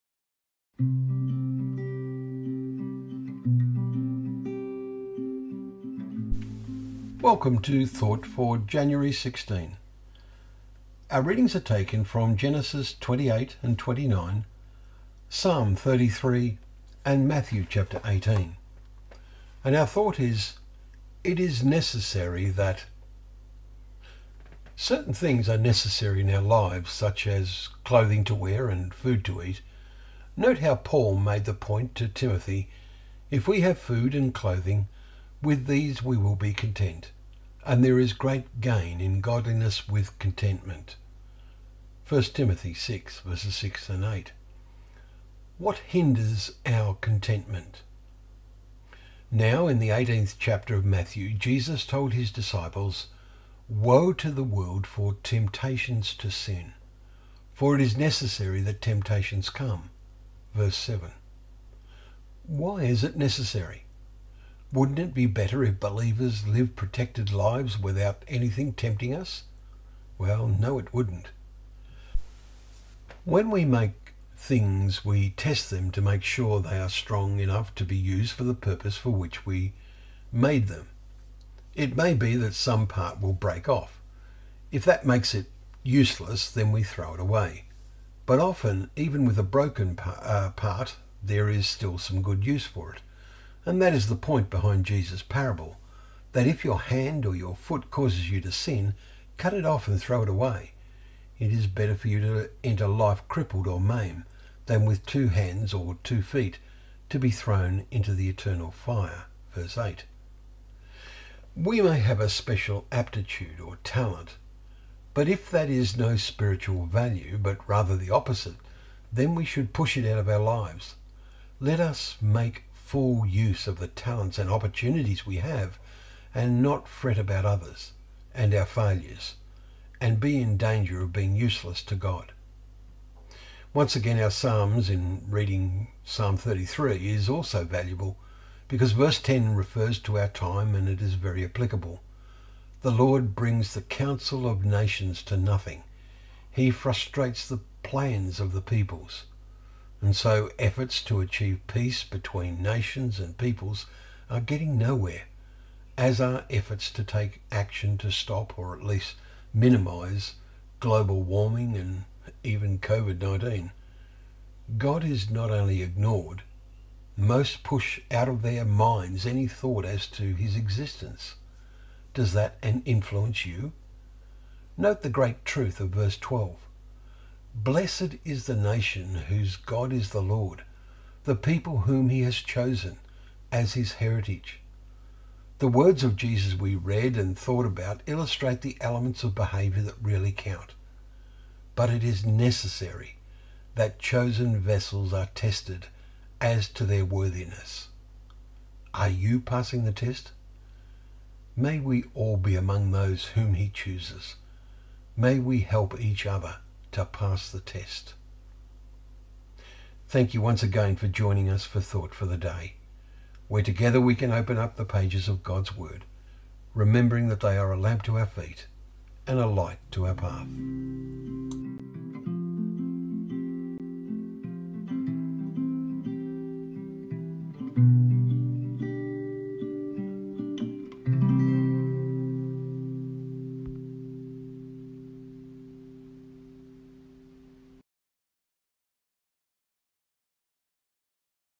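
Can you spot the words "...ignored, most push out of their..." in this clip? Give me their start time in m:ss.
2:45.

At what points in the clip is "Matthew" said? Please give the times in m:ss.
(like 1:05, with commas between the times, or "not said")
0:17, 0:50.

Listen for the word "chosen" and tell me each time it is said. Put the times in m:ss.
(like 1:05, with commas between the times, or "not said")
3:02, 3:13.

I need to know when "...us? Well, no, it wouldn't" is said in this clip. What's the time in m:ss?
1:09.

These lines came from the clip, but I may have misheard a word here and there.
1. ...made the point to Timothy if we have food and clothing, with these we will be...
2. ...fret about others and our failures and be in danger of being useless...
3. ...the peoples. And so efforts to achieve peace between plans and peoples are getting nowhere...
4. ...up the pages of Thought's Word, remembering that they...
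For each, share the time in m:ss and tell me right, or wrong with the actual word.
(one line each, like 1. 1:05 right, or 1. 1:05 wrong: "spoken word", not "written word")
1. 0:31 right
2. 2:06 right
3. 2:28 wrong: "nations", not "plans"
4. 3:34 wrong: "God", not "Thought".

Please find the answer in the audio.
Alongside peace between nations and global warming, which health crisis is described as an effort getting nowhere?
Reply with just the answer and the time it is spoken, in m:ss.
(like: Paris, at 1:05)
COVID-19, at 2:42.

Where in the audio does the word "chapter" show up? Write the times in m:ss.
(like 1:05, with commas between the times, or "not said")
0:17, 0:50.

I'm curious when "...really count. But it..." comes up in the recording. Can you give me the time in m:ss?
3:10.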